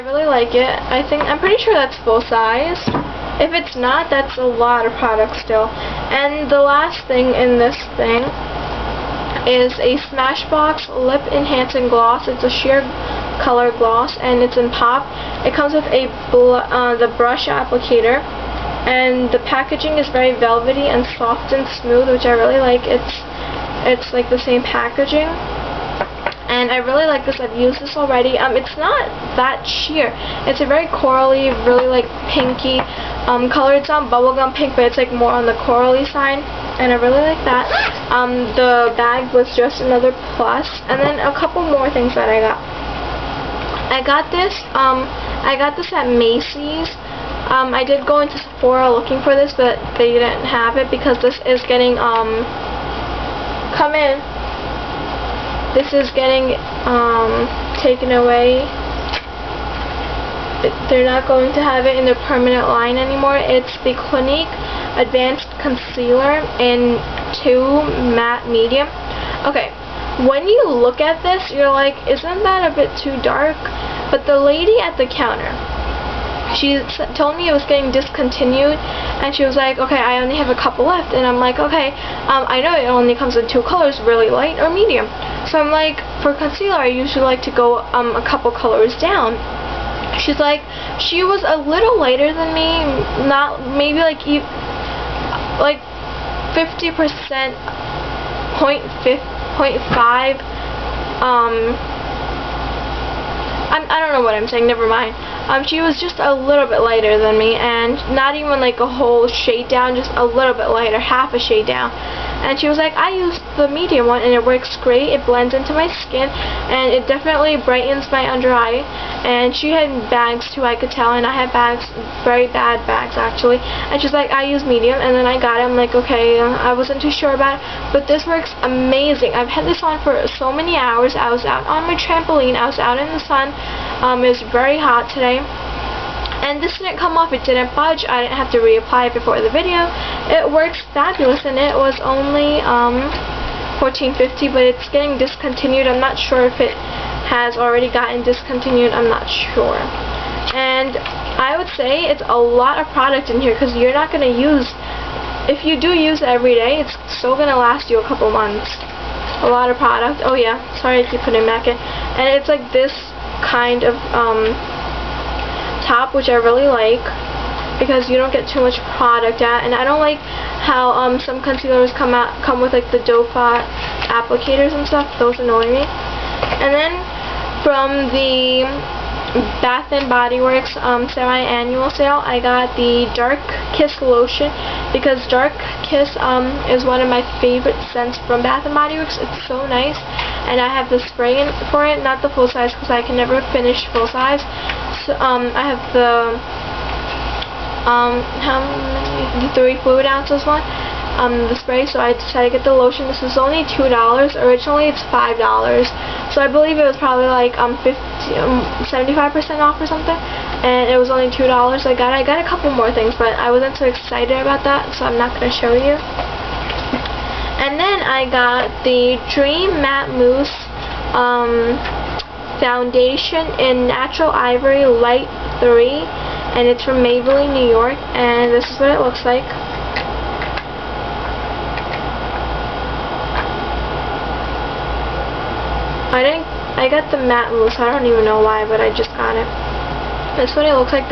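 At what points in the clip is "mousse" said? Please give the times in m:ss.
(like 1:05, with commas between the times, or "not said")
3:40, 3:57.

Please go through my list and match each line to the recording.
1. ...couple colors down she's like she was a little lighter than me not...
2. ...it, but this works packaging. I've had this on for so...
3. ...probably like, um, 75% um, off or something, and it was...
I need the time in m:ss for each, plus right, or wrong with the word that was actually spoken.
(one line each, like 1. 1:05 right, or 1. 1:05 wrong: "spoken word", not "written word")
1. 1:28 right
2. 2:07 wrong: "amazing", not "packaging"
3. 3:26 right.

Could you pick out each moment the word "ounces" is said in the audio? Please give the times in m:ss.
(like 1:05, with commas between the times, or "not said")
3:20.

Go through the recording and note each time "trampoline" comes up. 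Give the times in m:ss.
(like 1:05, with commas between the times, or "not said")
2:11.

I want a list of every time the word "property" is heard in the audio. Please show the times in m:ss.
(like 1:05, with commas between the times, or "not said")
not said.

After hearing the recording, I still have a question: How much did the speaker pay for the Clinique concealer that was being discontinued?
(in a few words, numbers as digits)
$14.50.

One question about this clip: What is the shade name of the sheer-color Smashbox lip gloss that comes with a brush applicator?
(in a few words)
Pop.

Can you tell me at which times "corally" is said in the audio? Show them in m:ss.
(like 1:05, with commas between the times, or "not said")
0:30, 0:35.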